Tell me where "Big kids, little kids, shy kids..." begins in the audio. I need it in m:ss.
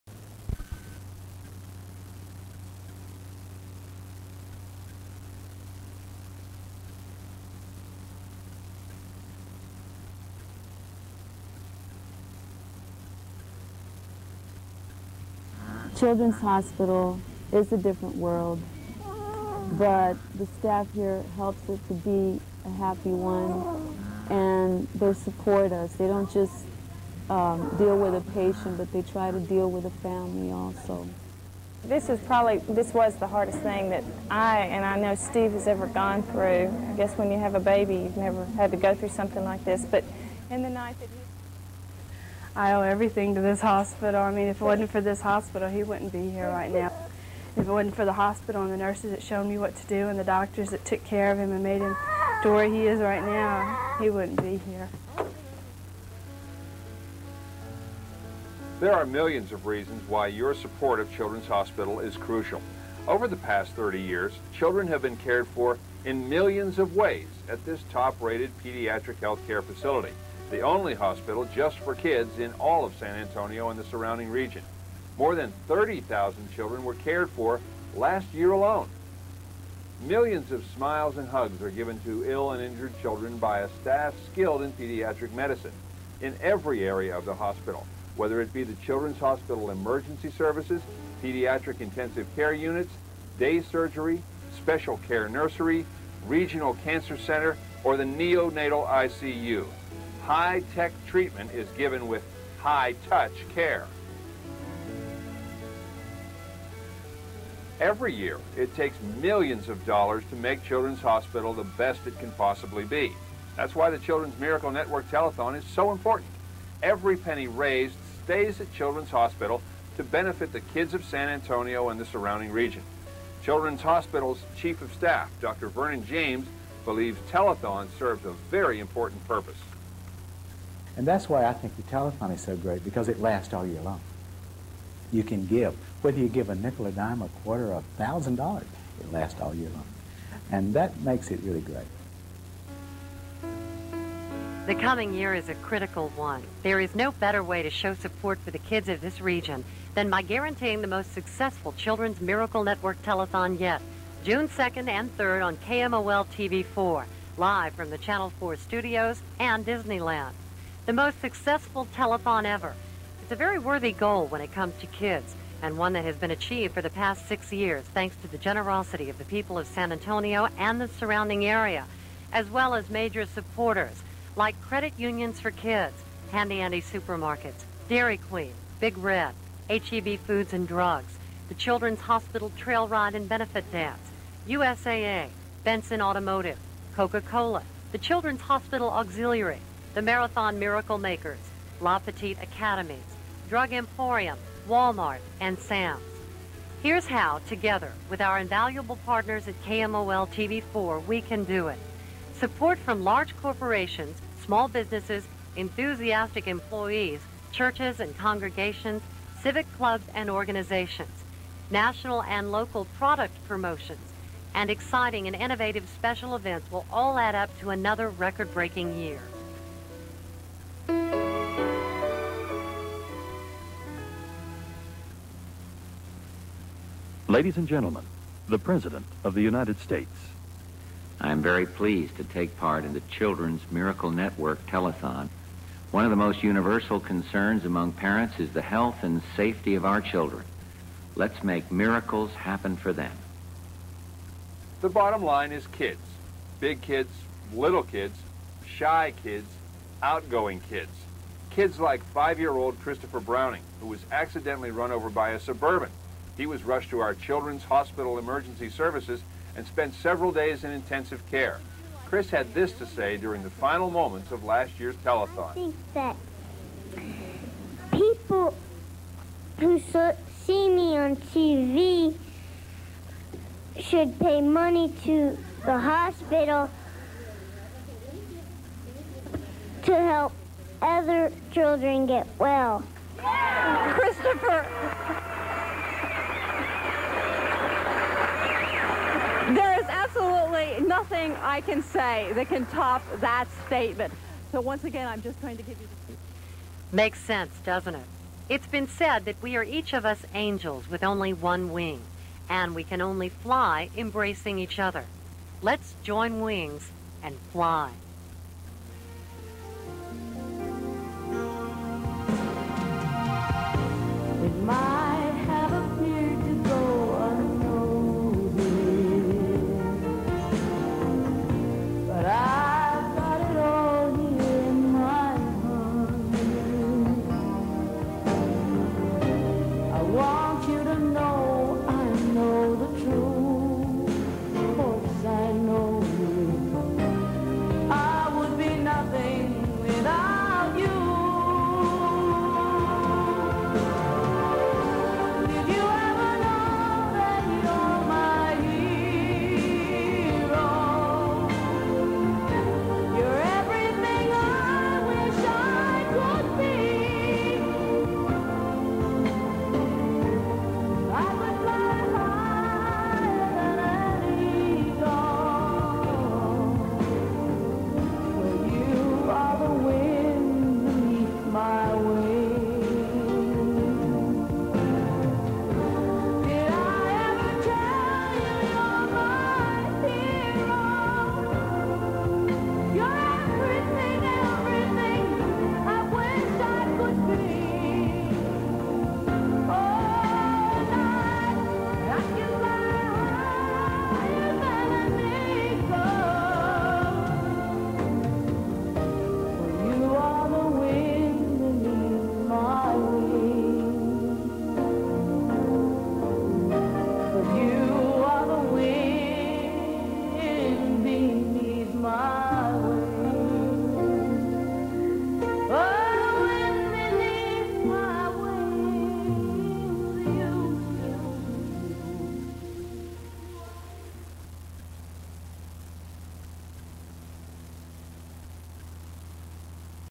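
4:06.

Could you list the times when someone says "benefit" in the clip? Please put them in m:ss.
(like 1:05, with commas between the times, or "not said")
2:00, 3:03.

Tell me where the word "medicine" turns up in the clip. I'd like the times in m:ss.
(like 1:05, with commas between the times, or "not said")
1:25.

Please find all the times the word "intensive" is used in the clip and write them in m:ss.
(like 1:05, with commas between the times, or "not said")
1:31, 4:20.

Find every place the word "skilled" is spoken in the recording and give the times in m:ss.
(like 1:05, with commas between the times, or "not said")
1:24.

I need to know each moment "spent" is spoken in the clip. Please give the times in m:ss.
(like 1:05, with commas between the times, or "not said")
4:19.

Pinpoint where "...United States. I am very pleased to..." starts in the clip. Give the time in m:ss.
3:49.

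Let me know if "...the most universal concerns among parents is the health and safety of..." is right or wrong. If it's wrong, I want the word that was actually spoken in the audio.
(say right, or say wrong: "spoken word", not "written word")
right.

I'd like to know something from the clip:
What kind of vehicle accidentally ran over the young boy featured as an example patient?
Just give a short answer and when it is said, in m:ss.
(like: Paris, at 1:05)
Suburban, at 4:15.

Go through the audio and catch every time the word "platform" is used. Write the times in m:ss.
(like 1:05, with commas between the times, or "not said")
not said.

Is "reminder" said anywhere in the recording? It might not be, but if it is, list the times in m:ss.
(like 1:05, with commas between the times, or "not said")
not said.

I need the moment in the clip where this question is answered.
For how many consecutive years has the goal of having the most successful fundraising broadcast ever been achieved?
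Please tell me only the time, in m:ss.
2:47.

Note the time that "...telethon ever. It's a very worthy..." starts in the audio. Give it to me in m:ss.
2:41.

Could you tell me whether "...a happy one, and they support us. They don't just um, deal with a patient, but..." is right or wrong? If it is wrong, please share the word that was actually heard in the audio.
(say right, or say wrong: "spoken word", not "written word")
right.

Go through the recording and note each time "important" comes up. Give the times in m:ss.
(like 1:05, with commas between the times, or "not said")
1:55, 2:08.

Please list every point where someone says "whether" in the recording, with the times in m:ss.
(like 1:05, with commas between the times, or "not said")
1:28, 2:16.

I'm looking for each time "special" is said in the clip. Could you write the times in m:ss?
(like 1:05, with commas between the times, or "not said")
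1:34, 3:35.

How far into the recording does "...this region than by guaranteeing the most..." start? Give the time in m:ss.
2:29.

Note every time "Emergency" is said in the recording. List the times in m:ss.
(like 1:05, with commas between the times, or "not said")
1:29, 4:18.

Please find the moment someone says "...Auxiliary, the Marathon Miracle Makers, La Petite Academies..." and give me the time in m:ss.
3:08.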